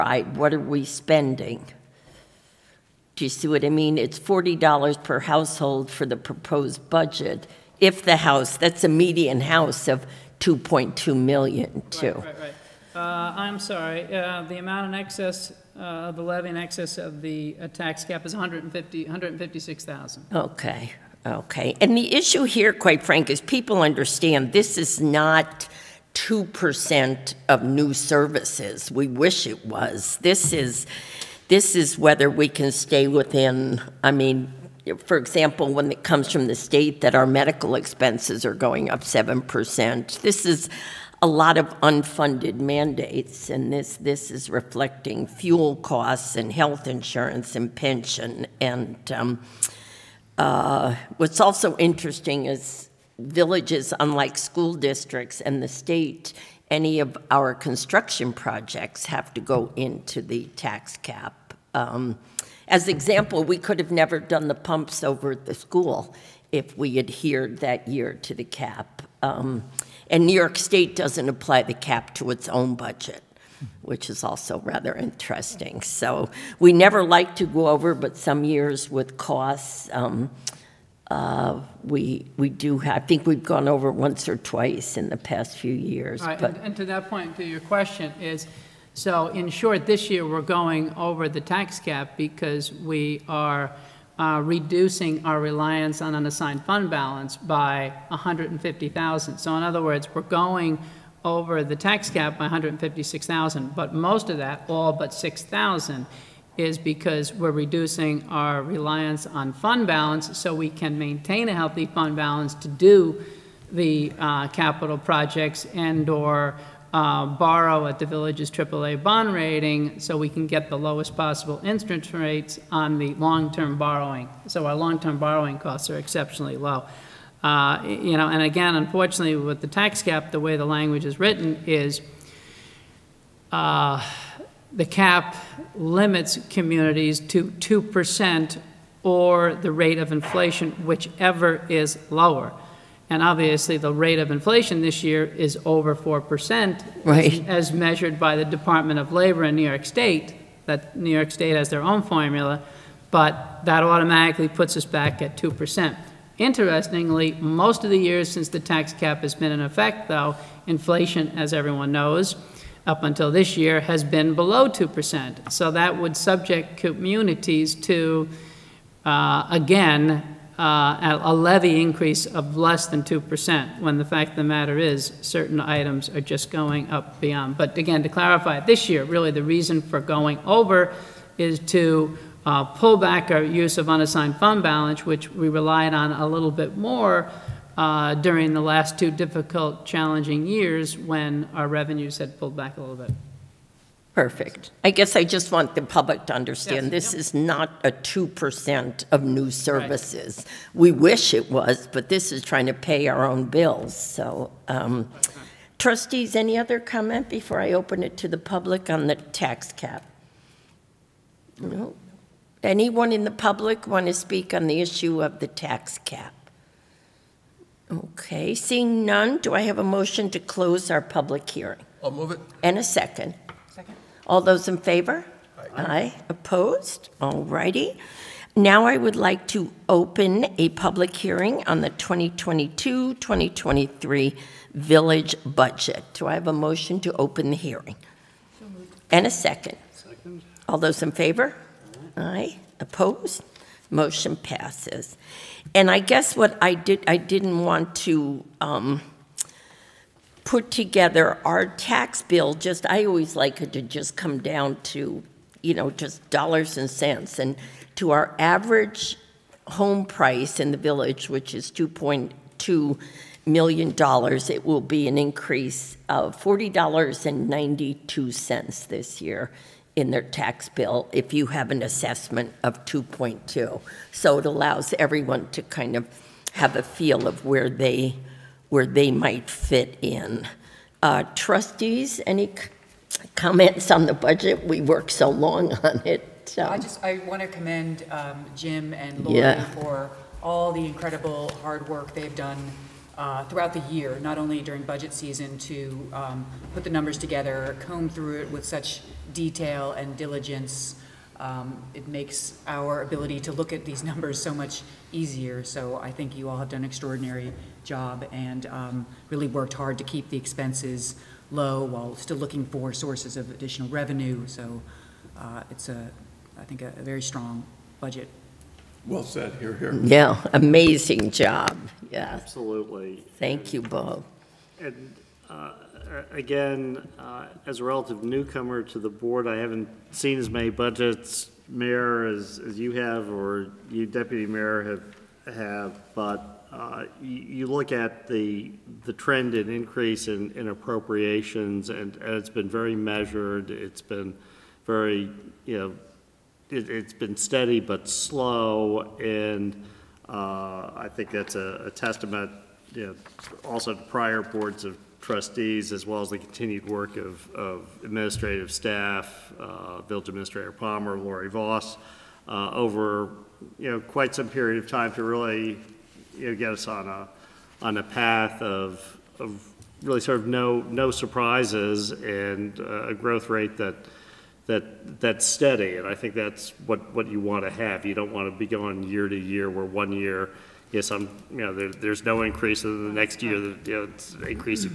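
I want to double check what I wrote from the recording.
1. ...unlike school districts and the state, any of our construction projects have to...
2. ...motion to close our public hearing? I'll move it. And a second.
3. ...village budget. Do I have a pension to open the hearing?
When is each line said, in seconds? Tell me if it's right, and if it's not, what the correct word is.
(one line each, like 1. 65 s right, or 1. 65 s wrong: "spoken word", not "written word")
1. 53 s right
2. 219 s right
3. 234 s wrong: "motion", not "pension".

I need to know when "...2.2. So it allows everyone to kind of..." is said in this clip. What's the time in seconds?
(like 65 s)
272 s.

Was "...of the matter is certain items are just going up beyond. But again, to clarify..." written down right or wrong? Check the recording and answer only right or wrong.
right.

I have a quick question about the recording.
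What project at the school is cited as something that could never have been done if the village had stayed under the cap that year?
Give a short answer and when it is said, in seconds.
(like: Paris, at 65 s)
the pumps, at 64 s.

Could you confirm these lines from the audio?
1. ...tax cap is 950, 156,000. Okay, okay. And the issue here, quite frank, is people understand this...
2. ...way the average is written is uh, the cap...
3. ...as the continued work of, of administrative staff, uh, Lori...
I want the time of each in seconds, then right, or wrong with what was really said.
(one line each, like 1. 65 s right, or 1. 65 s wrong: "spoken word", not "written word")
1. 17 s wrong: "150", not "950"
2. 130 s wrong: "language", not "average"
3. 356 s wrong: "Village", not "Lori".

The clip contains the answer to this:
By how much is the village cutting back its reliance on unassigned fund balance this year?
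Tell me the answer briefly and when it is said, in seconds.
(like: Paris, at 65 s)
150,000, at 98 s.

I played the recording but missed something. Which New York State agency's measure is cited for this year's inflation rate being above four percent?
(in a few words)
Department of Labor.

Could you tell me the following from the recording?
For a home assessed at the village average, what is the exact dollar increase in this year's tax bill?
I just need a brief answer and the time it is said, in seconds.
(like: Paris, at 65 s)
$40.92, at 266 s.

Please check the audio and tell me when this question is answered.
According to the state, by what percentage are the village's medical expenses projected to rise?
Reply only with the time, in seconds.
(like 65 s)
39 s.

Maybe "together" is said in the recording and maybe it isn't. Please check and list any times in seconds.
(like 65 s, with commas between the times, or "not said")
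250 s, 297 s.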